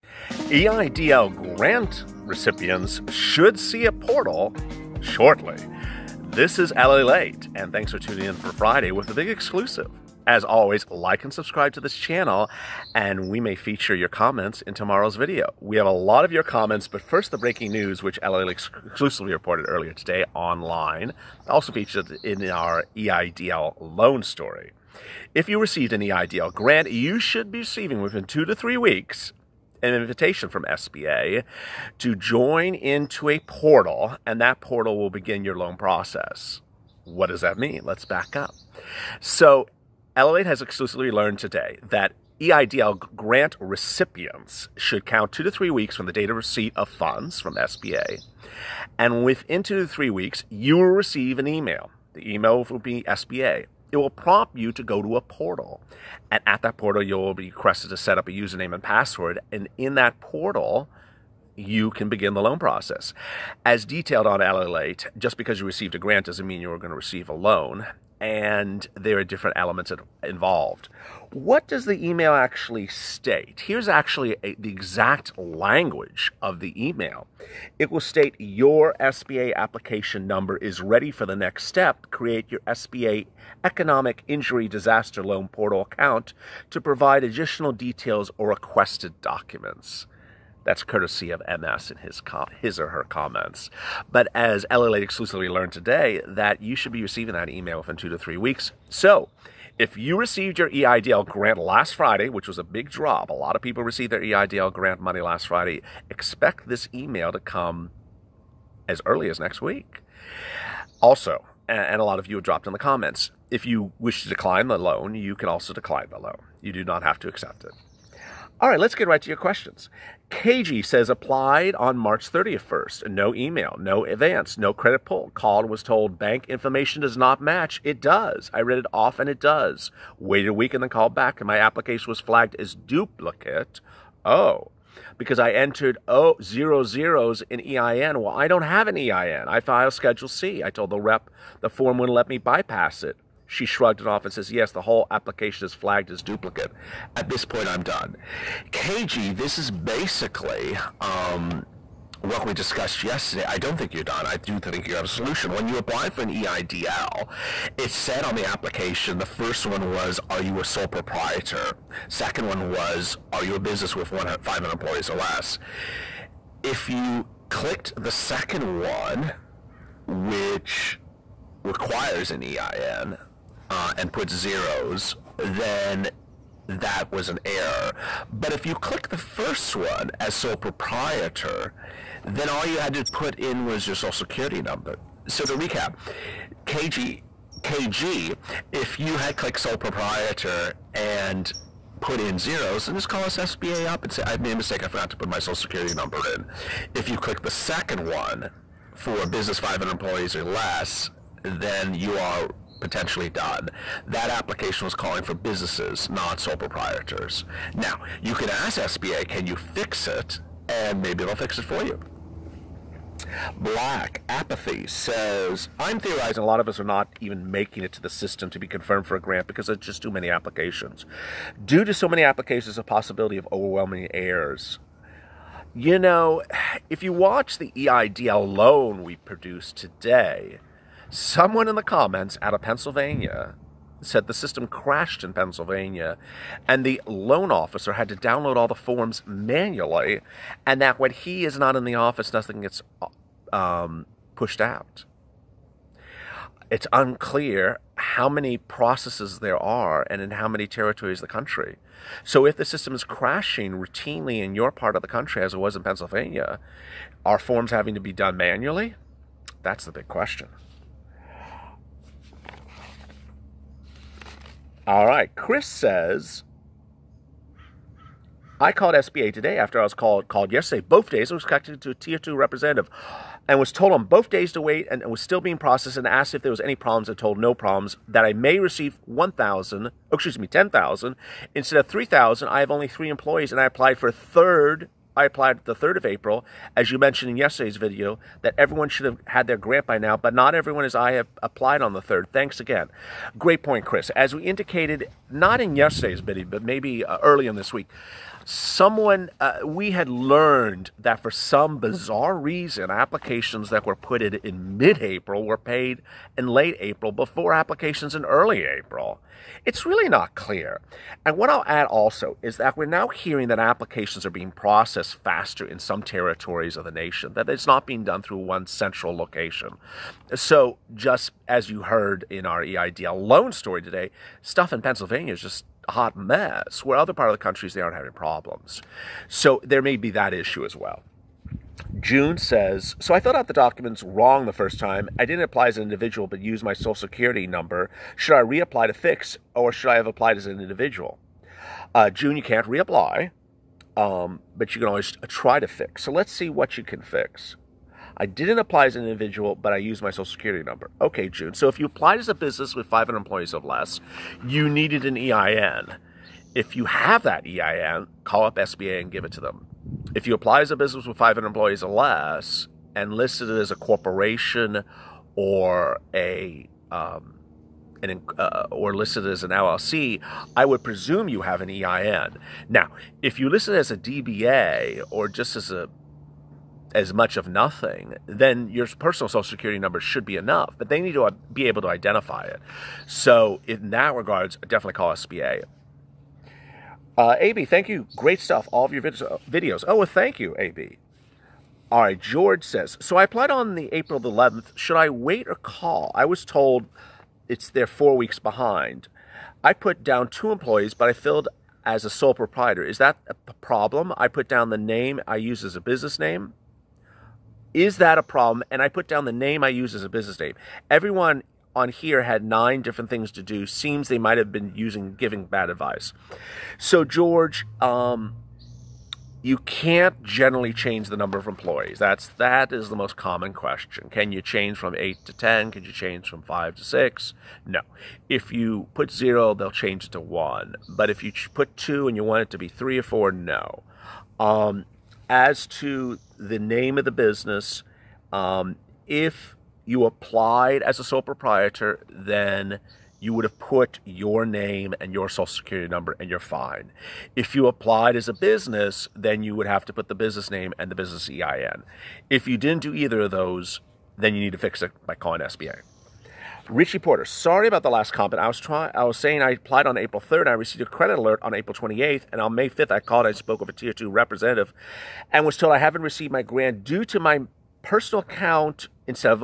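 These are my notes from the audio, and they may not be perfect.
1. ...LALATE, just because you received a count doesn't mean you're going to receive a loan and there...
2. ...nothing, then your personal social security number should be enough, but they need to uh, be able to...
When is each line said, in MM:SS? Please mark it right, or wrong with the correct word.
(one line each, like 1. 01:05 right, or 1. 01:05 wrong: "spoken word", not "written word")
1. 01:04 wrong: "grant", not "count"
2. 06:17 right.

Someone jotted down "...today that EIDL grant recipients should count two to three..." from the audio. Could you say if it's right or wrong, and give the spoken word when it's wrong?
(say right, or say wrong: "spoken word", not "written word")
right.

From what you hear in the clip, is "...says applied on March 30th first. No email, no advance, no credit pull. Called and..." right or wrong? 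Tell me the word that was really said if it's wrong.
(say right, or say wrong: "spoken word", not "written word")
right.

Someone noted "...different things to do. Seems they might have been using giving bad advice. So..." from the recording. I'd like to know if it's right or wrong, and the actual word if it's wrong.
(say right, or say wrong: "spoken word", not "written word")
right.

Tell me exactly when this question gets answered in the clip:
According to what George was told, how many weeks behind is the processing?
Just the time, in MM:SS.
06:37.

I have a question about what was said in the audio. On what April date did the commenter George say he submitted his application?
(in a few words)
April 11th.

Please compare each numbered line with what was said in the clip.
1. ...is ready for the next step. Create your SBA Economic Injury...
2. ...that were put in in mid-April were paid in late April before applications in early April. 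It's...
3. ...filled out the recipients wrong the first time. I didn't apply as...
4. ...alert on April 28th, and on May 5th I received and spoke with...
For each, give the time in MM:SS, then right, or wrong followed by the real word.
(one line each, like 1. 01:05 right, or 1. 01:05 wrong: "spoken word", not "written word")
1. 01:20 right
2. 05:03 right
3. 05:33 wrong: "documents", not "recipients"
4. 07:41 wrong: "called", not "received".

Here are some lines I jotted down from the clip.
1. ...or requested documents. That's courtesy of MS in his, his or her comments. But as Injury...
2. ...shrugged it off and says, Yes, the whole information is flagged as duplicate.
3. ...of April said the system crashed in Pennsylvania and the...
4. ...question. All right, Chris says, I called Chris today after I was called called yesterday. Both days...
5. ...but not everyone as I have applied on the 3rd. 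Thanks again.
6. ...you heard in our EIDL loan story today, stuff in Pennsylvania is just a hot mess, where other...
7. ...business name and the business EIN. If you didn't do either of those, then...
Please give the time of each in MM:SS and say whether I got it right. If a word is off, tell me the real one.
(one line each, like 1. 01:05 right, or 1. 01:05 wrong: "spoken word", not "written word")
1. 01:28 wrong: "LALATE", not "Injury"
2. 02:23 wrong: "application", not "information"
3. 03:52 wrong: "Pennsylvania", not "April"
4. 04:20 wrong: "SBA", not "Chris"
5. 04:50 right
6. 05:21 right
7. 07:30 right.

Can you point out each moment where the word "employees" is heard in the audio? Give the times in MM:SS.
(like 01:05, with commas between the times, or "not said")
02:44, 03:19, 04:43, 05:53, 06:01, 06:40, 07:01.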